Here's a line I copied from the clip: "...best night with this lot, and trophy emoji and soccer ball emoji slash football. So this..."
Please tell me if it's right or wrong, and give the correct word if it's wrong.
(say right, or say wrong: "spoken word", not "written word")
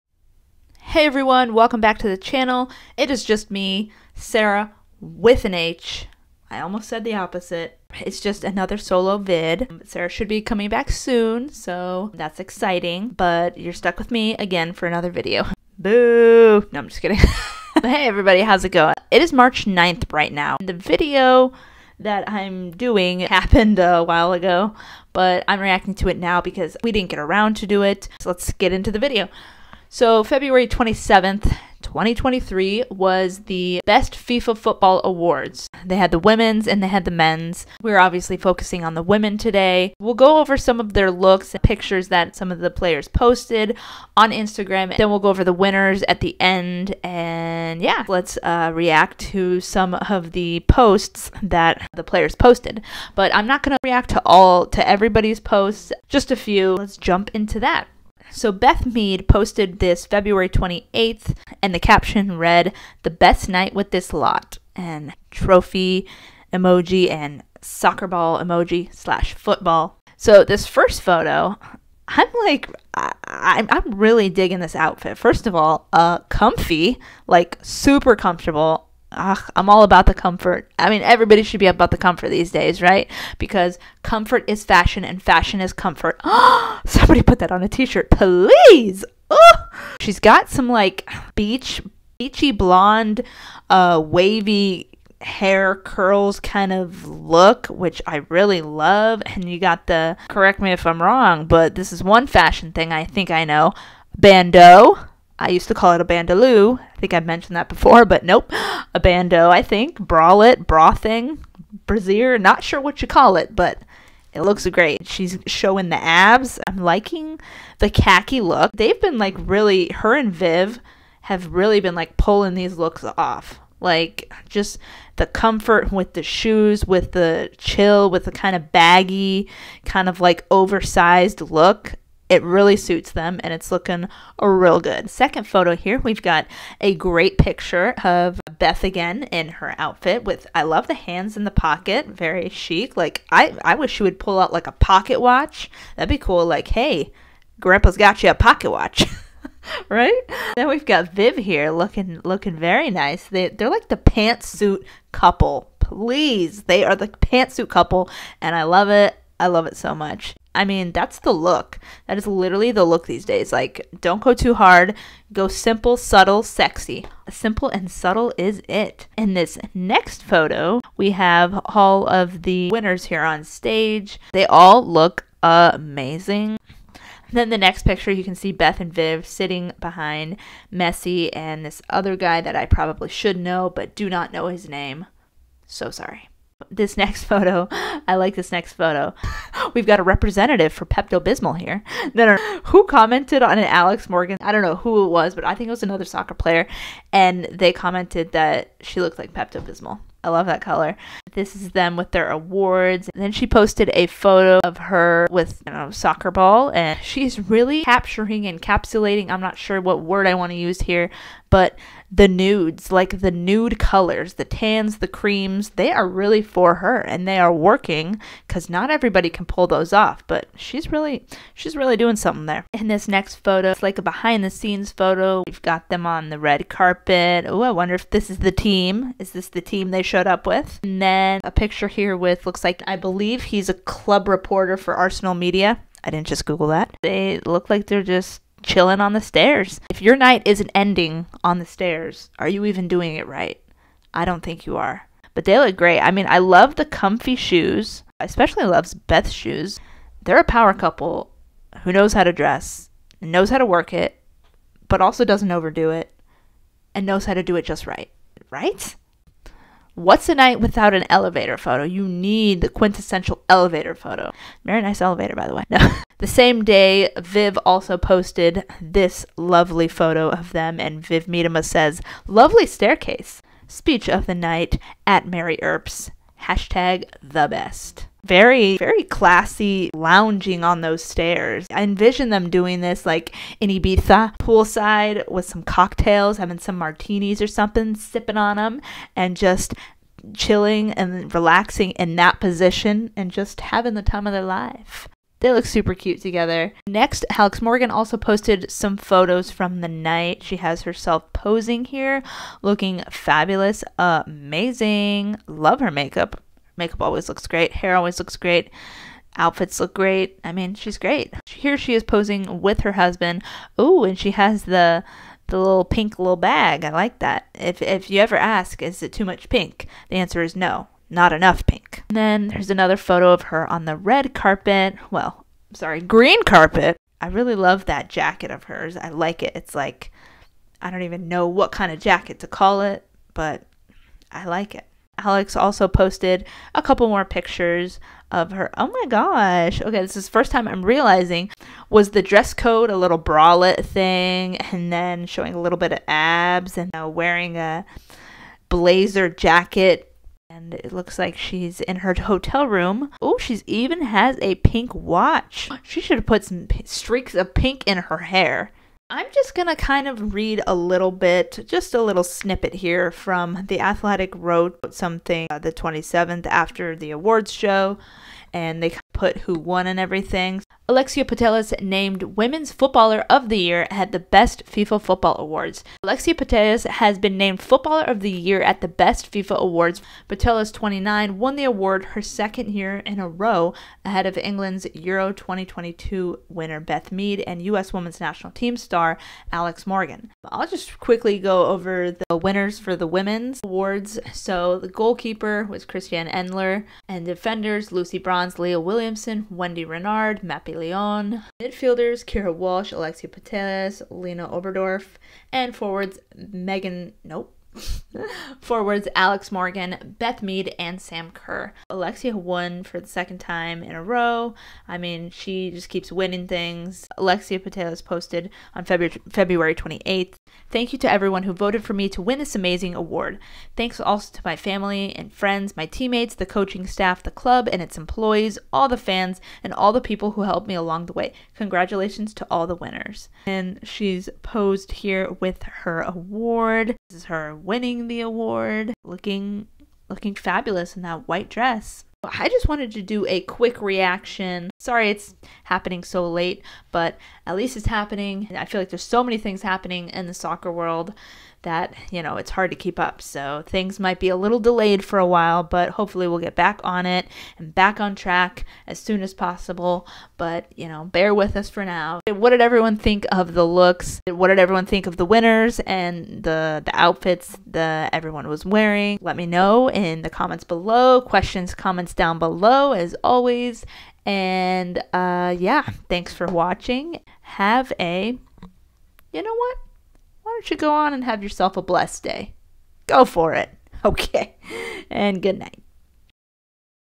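right.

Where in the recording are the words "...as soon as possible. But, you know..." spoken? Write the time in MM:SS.
07:38.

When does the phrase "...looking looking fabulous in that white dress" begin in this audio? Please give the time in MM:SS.
07:19.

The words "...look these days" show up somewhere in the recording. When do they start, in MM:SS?
02:42.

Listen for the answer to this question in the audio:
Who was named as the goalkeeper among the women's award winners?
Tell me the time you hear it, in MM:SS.
06:35.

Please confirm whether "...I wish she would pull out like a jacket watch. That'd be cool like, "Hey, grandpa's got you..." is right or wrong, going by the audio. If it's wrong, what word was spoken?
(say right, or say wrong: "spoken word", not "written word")
wrong: "pocket", not "jacket".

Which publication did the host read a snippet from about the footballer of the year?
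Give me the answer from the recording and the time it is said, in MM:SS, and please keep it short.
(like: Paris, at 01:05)
The Athletic, at 06:03.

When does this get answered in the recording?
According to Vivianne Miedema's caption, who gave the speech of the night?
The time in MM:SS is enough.
04:35.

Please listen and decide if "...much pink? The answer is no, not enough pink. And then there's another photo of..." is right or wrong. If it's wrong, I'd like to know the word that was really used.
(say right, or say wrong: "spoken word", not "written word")
right.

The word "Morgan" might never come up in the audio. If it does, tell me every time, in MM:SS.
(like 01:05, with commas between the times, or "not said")
03:14, 04:57, 06:29, 06:49.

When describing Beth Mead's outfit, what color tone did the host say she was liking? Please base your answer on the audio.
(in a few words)
khaki.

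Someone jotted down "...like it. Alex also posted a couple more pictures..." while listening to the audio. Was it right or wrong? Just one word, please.
right.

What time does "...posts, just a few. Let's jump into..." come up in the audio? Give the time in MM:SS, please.
00:55.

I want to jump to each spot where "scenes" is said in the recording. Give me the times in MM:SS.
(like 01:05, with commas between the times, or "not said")
03:44.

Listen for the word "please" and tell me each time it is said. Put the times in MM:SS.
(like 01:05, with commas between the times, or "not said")
01:28, 02:35.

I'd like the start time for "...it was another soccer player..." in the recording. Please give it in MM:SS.
03:15.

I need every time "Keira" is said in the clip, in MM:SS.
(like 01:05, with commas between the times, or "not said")
06:42.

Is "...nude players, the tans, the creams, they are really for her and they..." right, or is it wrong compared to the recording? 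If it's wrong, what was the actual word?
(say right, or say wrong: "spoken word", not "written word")
wrong: "colors", not "players".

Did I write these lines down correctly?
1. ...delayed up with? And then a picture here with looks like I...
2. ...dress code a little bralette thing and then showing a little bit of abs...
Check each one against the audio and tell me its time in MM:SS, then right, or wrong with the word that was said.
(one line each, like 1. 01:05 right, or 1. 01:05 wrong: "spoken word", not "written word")
1. 03:50 wrong: "showed", not "delayed"
2. 05:42 right.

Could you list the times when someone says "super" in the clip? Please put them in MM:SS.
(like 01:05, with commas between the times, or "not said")
01:17, 04:55.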